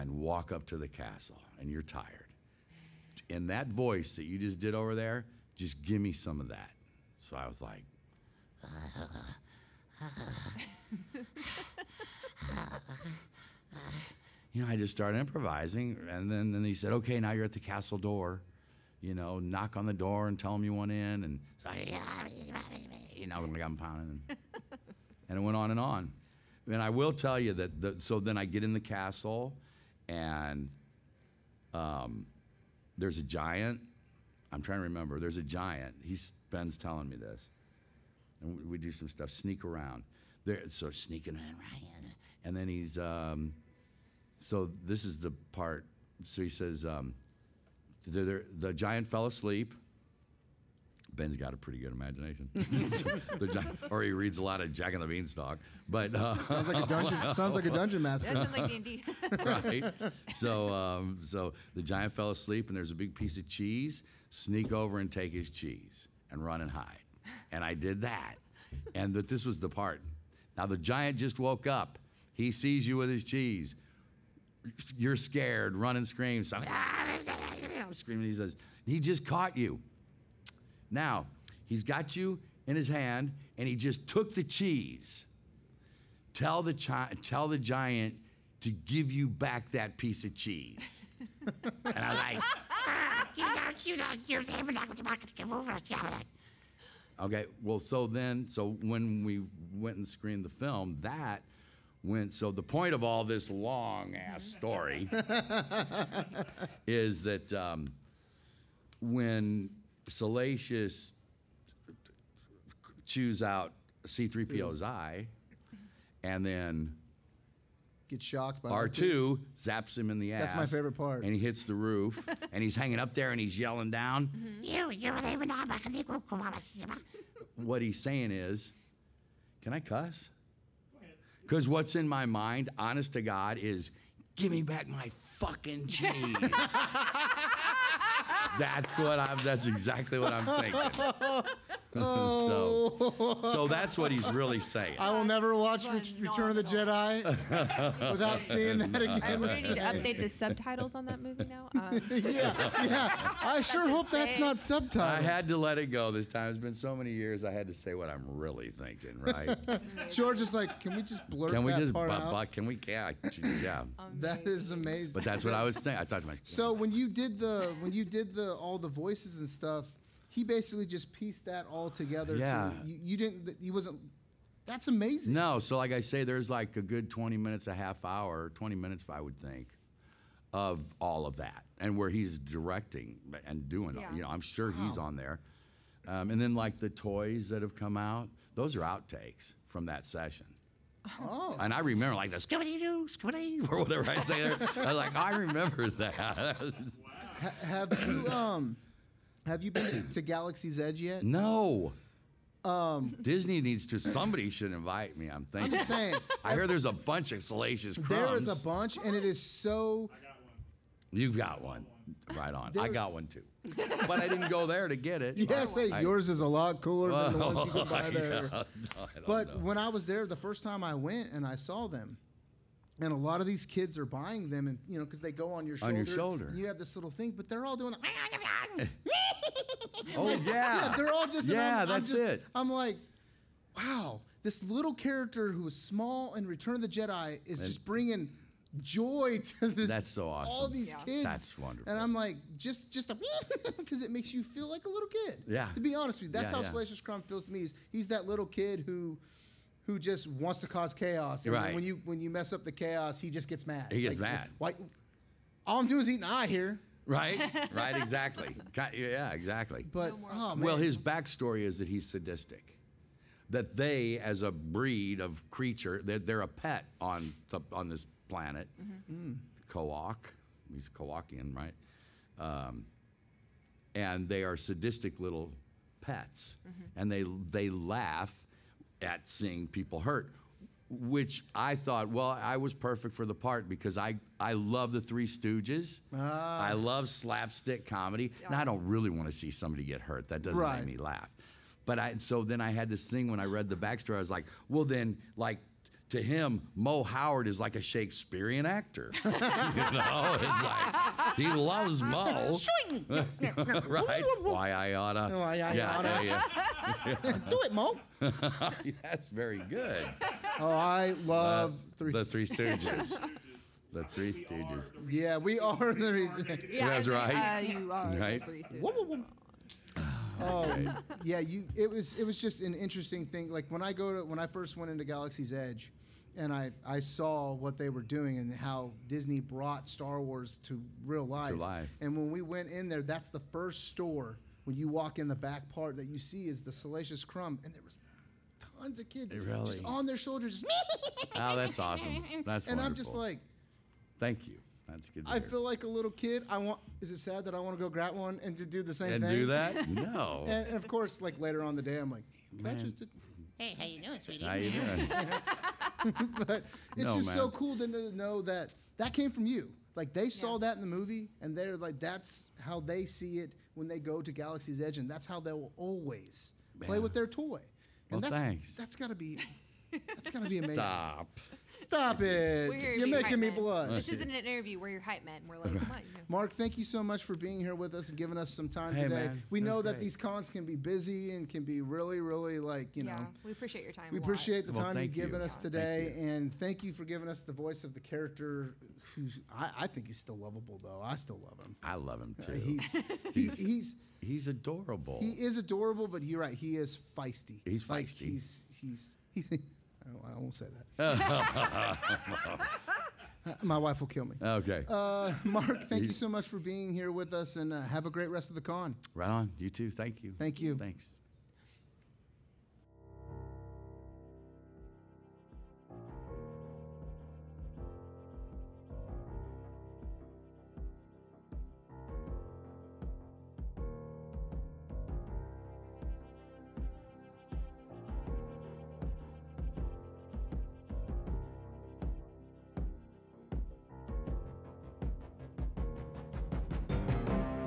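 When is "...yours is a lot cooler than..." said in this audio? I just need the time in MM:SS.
03:36.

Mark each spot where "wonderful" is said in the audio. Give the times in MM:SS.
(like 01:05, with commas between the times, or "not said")
04:01, 05:42.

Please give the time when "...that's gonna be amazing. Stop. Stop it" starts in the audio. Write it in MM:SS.
06:10.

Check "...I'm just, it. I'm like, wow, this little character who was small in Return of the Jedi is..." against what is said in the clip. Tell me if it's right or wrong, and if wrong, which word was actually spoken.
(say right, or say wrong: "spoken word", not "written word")
right.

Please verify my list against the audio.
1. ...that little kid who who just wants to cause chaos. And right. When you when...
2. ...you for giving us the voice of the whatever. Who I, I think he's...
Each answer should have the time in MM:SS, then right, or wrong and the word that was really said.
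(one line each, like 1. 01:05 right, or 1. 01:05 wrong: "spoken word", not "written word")
1. 04:08 right
2. 06:26 wrong: "character", not "whatever".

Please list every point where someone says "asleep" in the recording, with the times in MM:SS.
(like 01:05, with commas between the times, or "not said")
00:49, 01:02.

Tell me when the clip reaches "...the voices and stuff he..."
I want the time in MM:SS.
02:48.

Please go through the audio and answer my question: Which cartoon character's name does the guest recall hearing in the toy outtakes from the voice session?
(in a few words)
Scooby Doo.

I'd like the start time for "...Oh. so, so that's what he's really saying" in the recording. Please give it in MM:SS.
02:21.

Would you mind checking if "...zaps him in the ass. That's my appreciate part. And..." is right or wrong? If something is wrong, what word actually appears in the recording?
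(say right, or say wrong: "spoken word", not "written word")
wrong: "favorite", not "appreciate".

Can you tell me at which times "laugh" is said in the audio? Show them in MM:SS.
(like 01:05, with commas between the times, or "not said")
04:37, 04:50.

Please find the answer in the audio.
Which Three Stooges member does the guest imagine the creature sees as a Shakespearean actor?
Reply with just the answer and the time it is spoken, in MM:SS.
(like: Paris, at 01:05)
Mo Howard, at 04:56.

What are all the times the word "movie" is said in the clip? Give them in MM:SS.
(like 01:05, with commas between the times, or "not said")
02:31, 06:00.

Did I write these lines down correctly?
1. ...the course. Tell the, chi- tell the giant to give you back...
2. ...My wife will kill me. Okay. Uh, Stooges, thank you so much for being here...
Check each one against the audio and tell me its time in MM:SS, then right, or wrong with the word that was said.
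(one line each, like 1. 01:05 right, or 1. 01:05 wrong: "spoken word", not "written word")
1. 01:24 wrong: "cheese", not "course"
2. 06:43 wrong: "Mark", not "Stooges".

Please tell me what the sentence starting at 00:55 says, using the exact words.
But uh, sounds like a dungeon.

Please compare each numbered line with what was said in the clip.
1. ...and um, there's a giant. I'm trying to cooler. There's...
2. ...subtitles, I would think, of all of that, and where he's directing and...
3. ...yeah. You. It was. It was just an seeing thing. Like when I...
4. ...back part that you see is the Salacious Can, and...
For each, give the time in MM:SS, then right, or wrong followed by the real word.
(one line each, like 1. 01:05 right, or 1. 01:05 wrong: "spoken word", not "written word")
1. 00:30 wrong: "remember", not "cooler"
2. 02:58 wrong: "minutes", not "subtitles"
3. 05:21 wrong: "interesting", not "seeing"
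4. 05:35 wrong: "Crumb", not "Can".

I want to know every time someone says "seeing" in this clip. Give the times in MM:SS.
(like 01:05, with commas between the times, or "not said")
02:28, 04:39.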